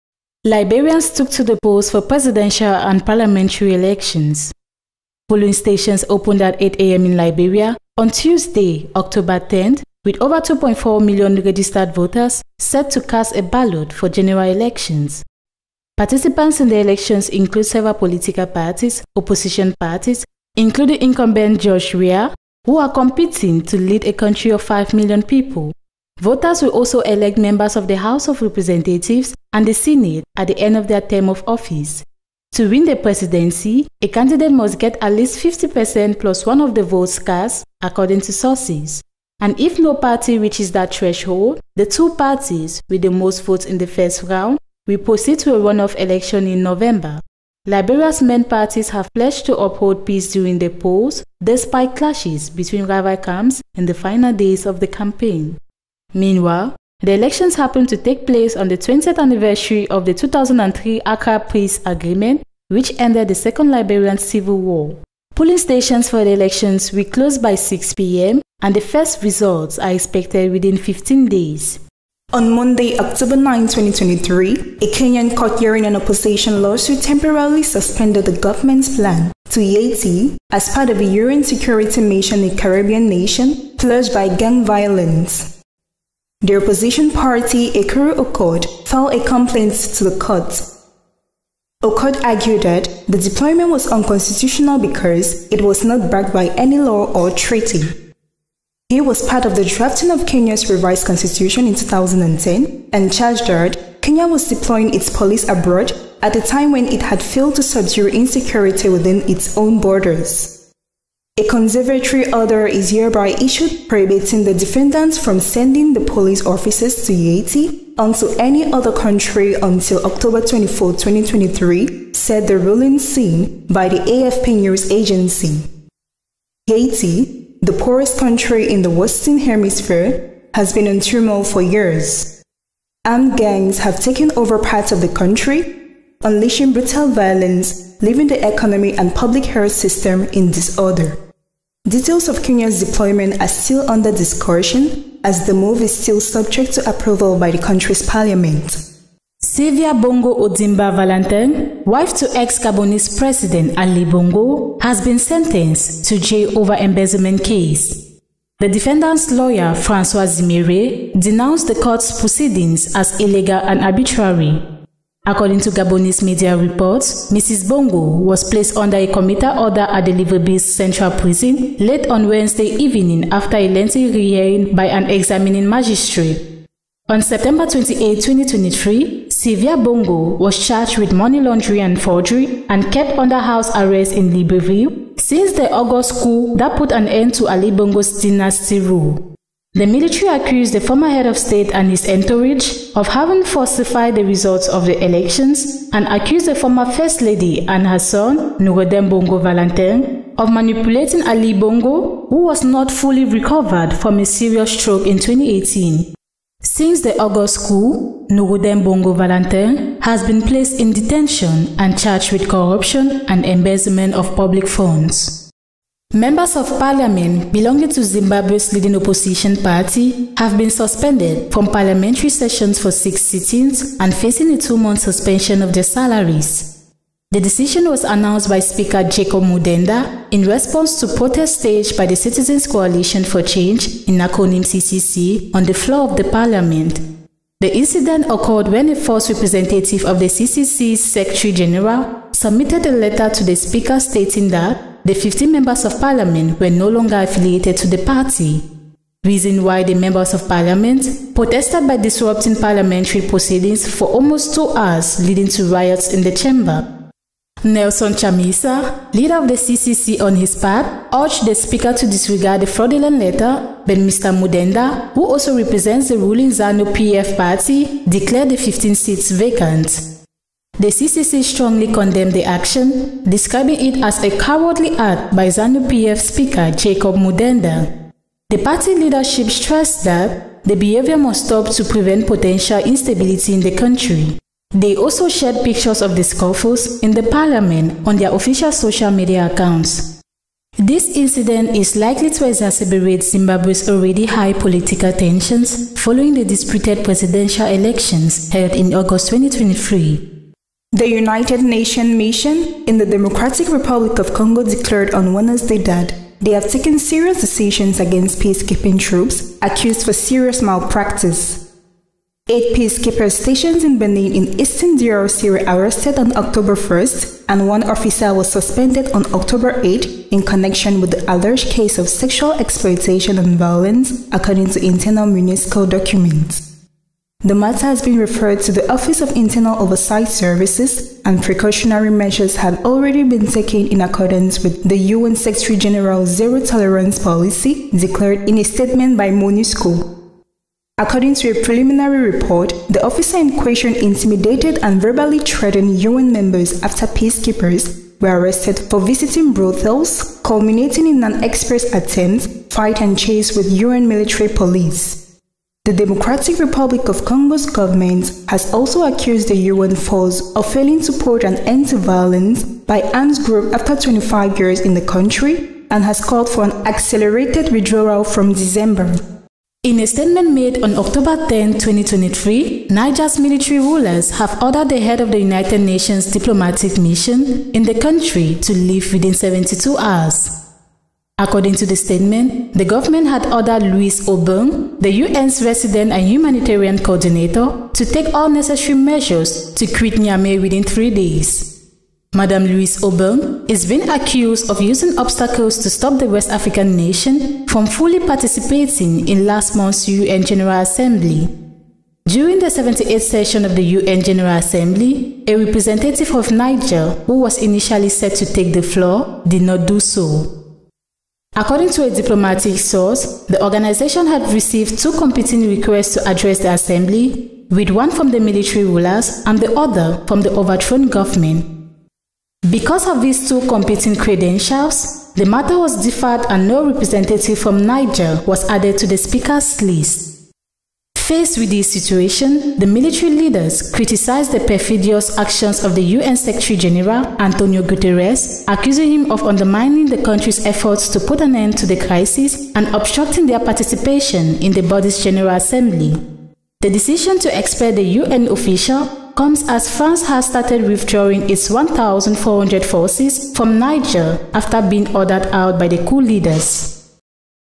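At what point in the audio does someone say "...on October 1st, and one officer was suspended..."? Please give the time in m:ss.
5:16.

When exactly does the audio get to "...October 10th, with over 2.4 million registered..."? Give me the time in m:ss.
0:08.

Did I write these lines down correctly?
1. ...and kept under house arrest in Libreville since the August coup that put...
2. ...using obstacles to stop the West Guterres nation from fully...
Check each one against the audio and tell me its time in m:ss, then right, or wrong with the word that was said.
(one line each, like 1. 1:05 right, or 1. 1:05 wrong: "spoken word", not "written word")
1. 3:02 right
2. 6:34 wrong: "African", not "Guterres".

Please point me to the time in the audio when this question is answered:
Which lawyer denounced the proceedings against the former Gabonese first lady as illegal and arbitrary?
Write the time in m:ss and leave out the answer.
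2:39.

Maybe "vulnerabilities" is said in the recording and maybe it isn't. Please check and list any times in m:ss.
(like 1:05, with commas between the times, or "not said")
not said.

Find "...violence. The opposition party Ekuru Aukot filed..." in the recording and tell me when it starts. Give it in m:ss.
1:24.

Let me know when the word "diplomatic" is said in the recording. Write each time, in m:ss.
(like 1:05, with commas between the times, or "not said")
6:16, 6:52.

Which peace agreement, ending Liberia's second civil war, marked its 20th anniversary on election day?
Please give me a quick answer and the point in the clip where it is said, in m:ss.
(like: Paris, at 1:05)
Accra Peace Agreement, at 1:01.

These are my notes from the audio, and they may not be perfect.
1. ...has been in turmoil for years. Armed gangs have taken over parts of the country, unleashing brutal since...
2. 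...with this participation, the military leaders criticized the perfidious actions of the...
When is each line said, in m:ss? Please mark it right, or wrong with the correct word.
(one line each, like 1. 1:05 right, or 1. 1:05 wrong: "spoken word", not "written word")
1. 2:10 wrong: "violence", not "since"
2. 7:11 wrong: "situation", not "participation".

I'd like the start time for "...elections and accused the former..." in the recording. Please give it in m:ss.
3:15.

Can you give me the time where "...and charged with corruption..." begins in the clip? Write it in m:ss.
3:31.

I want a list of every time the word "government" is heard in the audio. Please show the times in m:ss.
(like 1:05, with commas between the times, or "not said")
1:18, 5:57, 6:22, 7:01.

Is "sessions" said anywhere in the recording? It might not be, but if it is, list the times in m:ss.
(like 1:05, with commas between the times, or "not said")
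3:42, 6:43.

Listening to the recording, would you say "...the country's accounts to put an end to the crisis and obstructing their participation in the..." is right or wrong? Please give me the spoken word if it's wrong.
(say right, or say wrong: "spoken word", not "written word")
wrong: "efforts", not "accounts".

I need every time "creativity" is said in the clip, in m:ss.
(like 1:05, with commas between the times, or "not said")
not said.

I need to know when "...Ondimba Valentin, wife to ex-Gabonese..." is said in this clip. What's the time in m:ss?
2:30.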